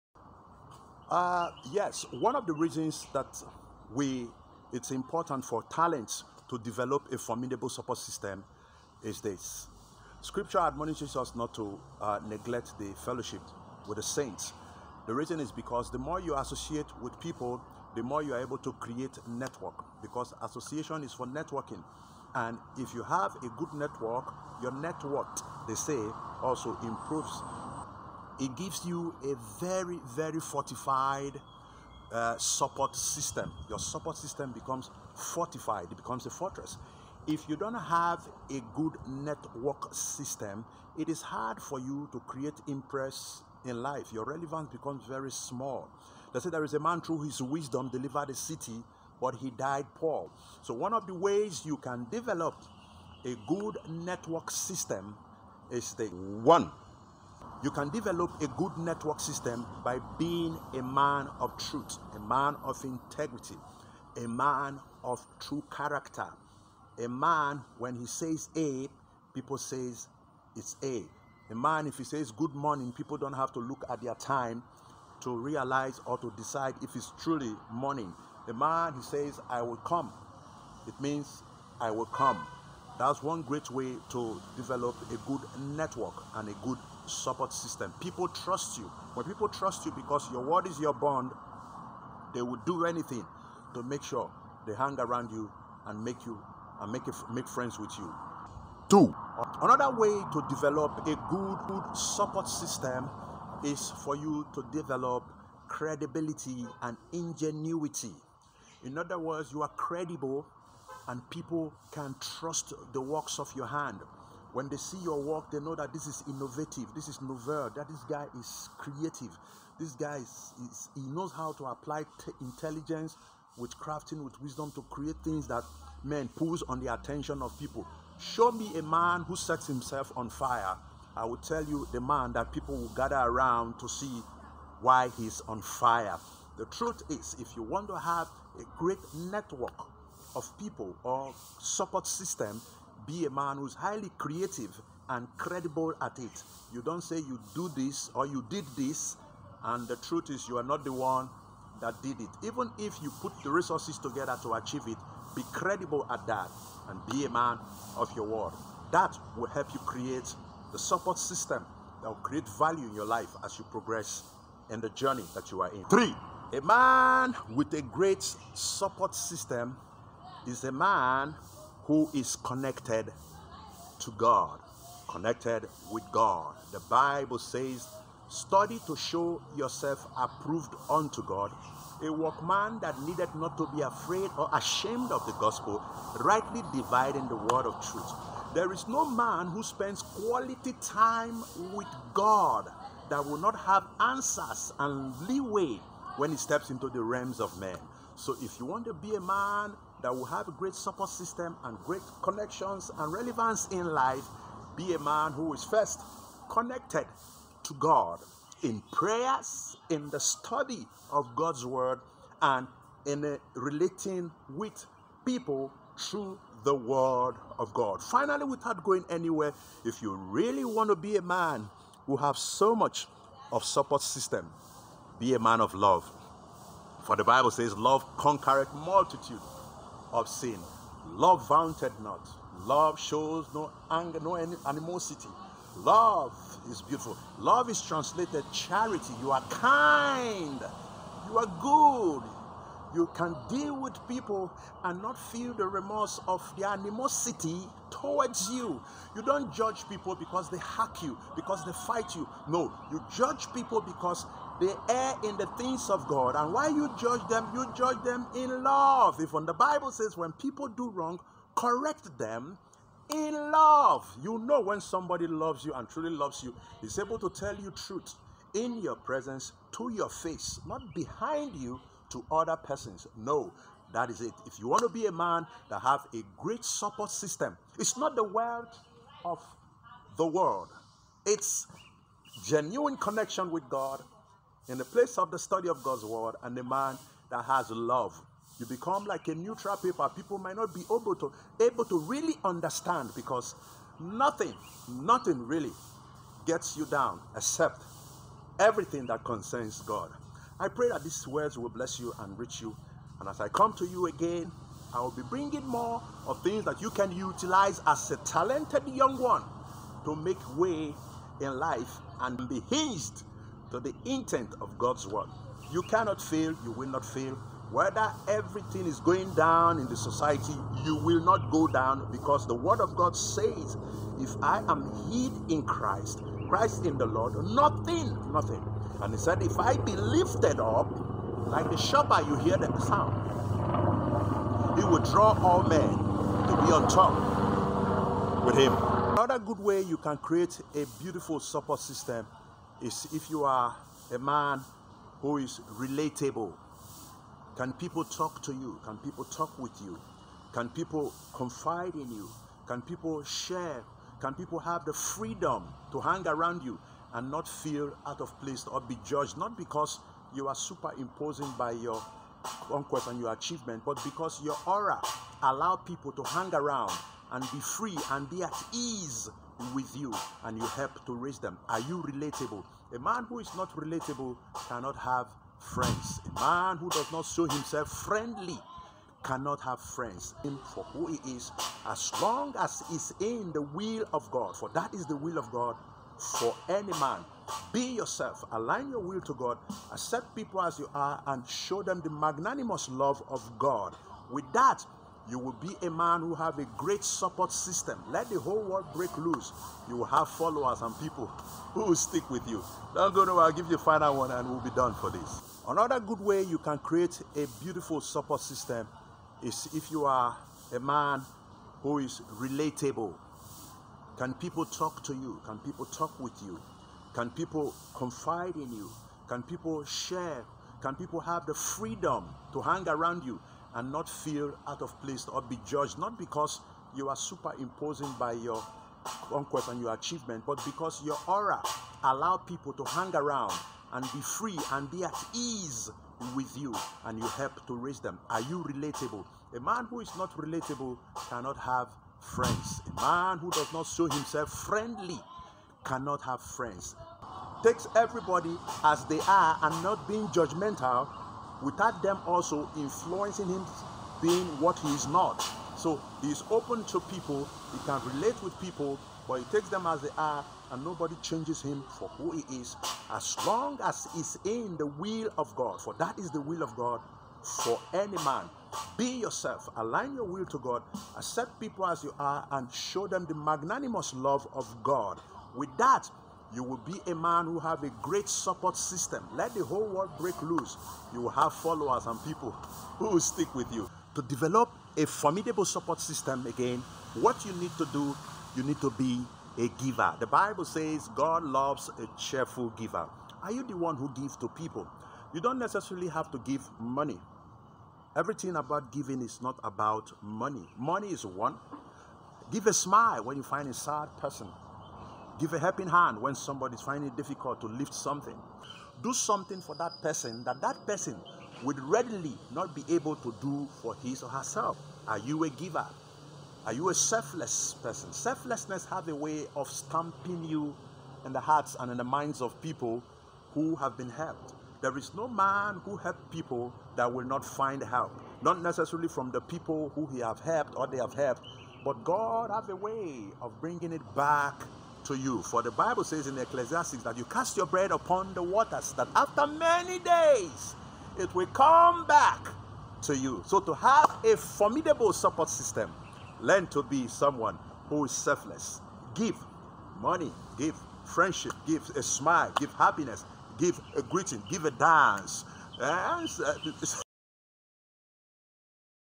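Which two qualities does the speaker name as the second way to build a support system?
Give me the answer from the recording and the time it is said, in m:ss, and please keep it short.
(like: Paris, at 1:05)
Credibility and ingenuity, at 1:45.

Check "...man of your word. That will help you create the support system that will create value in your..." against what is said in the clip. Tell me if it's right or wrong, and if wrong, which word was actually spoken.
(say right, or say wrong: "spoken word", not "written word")
right.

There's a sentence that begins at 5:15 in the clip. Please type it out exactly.
You cannot fail, you will not fail.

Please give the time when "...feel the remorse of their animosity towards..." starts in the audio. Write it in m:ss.
4:05.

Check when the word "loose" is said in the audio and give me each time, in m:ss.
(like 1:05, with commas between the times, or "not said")
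6:39, 8:00.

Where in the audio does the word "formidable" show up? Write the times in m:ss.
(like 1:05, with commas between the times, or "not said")
0:07, 8:05, 9:04.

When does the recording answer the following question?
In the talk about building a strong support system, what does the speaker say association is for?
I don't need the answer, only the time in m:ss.
0:20.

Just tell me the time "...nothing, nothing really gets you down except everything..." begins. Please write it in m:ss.
4:53.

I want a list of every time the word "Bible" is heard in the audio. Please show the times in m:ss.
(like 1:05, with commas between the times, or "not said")
2:56, 3:47, 4:19, 8:10, 8:55.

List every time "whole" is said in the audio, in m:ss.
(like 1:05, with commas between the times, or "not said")
6:38, 7:59.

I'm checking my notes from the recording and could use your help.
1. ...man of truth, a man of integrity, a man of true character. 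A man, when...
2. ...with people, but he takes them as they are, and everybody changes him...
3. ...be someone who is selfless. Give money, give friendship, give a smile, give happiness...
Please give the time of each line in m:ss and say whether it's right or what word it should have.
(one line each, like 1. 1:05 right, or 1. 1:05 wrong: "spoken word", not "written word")
1. 1:00 right
2. 7:38 wrong: "nobody", not "everybody"
3. 9:06 right.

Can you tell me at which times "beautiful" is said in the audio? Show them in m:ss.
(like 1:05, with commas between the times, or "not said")
3:56, 5:41, 6:47.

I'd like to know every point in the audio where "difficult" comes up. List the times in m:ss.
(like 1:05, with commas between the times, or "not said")
8:27.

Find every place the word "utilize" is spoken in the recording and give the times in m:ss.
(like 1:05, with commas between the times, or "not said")
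5:07.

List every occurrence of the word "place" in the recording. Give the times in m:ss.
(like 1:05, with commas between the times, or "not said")
4:44, 5:58, 7:05.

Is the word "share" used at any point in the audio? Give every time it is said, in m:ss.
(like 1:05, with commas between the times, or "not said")
5:53, 6:59.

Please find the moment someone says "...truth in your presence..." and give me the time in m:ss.
4:27.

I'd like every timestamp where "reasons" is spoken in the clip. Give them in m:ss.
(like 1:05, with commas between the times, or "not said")
0:02, 0:15.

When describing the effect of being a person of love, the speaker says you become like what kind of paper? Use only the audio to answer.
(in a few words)
Neutral paper.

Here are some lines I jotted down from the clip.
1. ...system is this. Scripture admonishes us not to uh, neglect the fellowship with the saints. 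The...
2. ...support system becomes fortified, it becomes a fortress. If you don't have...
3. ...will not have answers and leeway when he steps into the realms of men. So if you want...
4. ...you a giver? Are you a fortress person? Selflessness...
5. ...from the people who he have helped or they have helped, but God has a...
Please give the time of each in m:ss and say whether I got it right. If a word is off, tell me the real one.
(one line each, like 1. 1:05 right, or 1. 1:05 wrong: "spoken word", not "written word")
1. 0:07 right
2. 0:33 right
3. 3:13 right
4. 8:35 wrong: "selfless", not "fortress"
5. 8:49 right.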